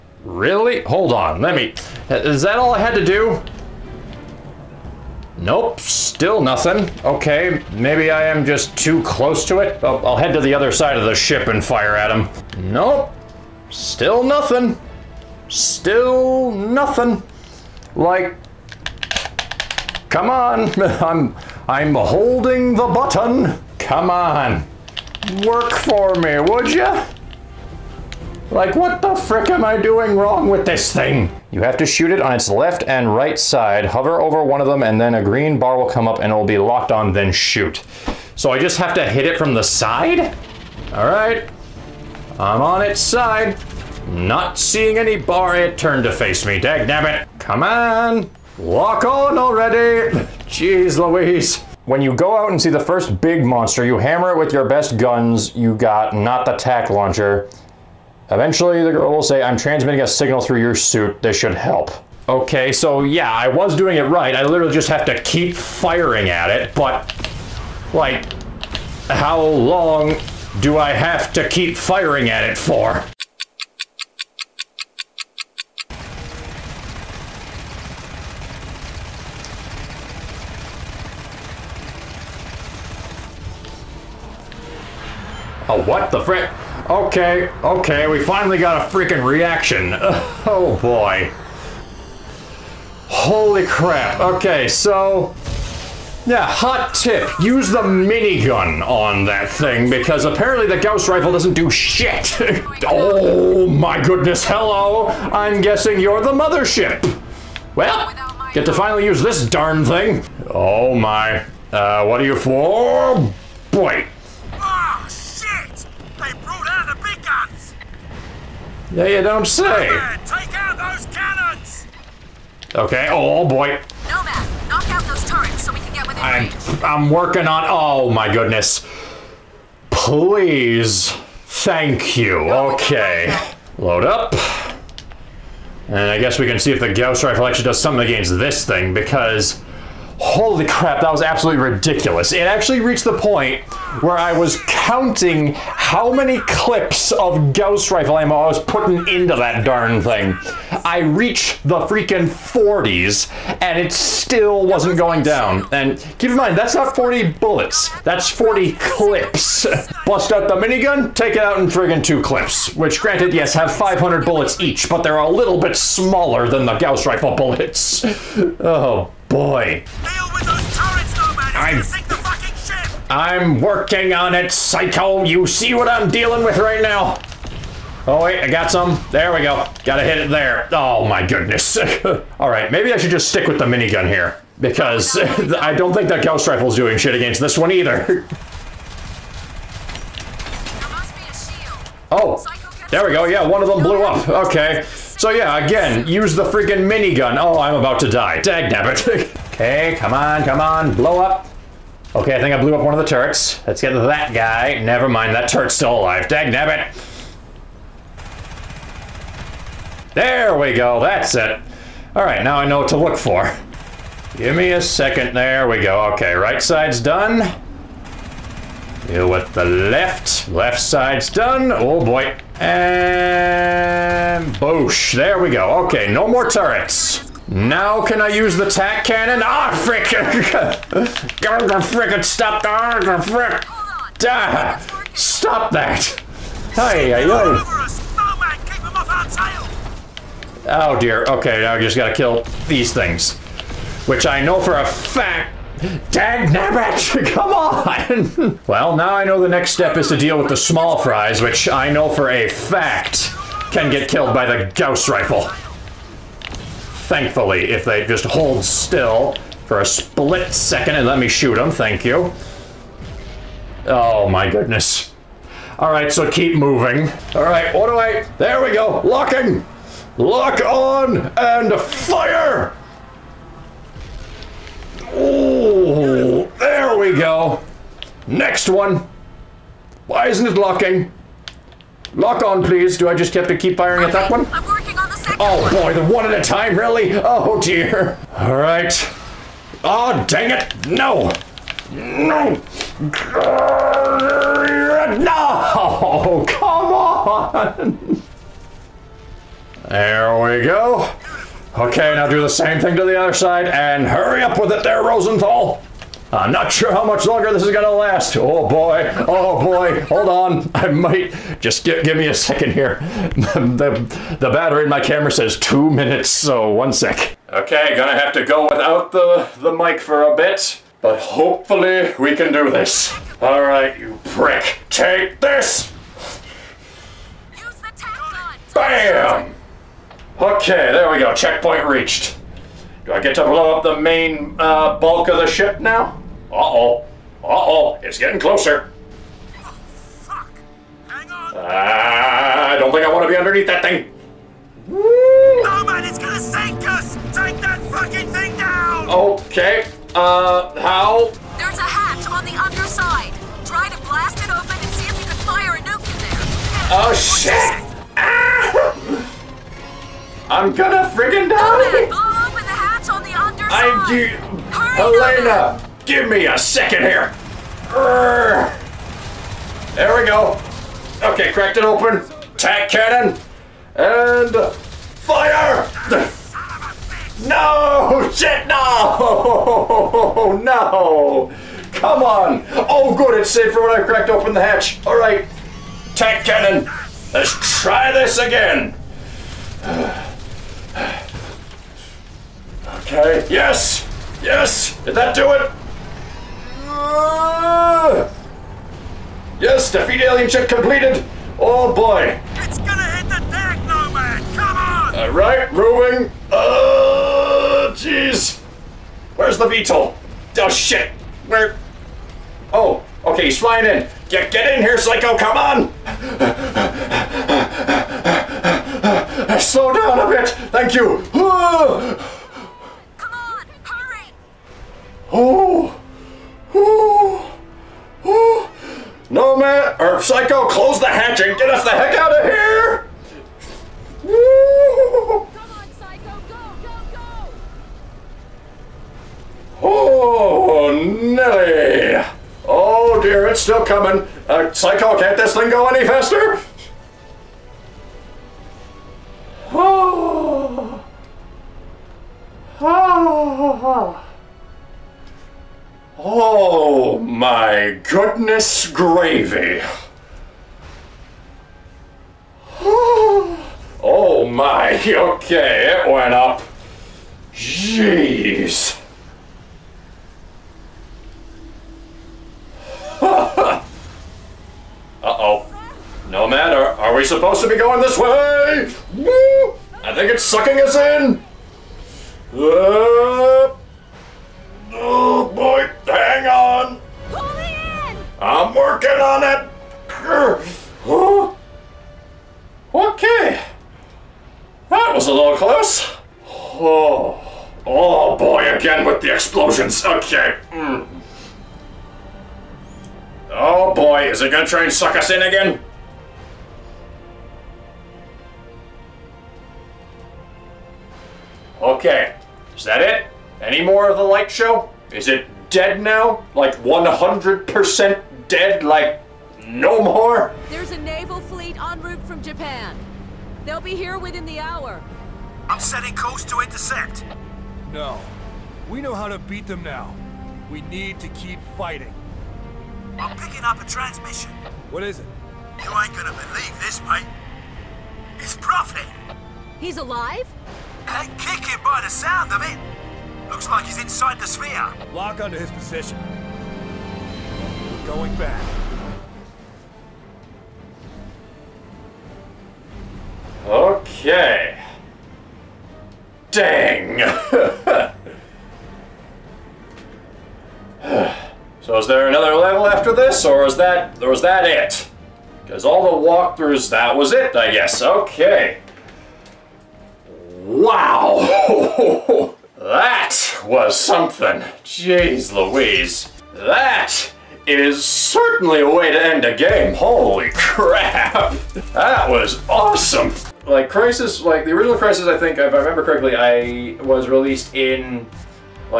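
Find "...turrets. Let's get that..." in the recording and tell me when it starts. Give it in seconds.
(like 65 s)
203 s.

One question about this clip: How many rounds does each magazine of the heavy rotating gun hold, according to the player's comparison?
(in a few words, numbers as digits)
500.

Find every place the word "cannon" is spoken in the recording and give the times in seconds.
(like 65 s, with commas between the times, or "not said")
121 s, 229 s, 372 s, 386 s.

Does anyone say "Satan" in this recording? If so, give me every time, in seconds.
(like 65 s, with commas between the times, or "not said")
not said.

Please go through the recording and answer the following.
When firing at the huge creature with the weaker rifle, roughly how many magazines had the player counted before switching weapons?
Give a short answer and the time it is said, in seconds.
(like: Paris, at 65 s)
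40s, at 152 s.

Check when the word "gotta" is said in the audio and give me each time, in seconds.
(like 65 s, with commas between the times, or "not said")
179 s, 241 s.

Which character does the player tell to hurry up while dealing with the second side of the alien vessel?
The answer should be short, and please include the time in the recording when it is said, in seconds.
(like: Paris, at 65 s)
Rosenthal, at 305 s.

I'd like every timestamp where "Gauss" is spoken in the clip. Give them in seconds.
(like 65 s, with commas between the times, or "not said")
100 s, 136 s, 147 s, 166 s, 186 s, 254 s.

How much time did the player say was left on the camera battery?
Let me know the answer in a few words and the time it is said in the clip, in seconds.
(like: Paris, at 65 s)
Two minutes, at 315 s.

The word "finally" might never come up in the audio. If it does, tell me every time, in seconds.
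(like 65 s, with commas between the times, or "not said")
88 s, 108 s.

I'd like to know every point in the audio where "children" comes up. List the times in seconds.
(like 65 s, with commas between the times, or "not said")
not said.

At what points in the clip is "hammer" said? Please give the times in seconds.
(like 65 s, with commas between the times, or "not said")
53 s.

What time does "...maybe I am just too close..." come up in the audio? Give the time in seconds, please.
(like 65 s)
7 s.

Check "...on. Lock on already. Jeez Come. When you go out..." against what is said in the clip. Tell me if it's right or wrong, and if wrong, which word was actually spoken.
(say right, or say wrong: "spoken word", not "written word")
wrong: "Louise", not "Come".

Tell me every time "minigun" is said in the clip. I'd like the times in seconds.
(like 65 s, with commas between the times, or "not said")
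97 s, 160 s, 183 s, 196 s.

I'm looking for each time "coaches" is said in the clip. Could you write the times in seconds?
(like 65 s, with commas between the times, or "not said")
not said.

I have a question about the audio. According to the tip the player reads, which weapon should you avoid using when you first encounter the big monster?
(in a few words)
Tack launcher.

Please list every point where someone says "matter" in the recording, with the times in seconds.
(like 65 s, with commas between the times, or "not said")
476 s.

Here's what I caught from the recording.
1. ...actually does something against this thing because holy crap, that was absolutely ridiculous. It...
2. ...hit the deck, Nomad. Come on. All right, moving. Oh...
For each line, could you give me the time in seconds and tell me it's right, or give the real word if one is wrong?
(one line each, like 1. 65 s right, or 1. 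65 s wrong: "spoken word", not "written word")
1. 137 s right
2. 403 s right.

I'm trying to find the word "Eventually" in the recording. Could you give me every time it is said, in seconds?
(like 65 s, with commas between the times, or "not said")
58 s.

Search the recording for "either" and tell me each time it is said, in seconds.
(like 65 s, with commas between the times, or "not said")
187 s.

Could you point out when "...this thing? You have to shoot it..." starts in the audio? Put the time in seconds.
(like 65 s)
30 s.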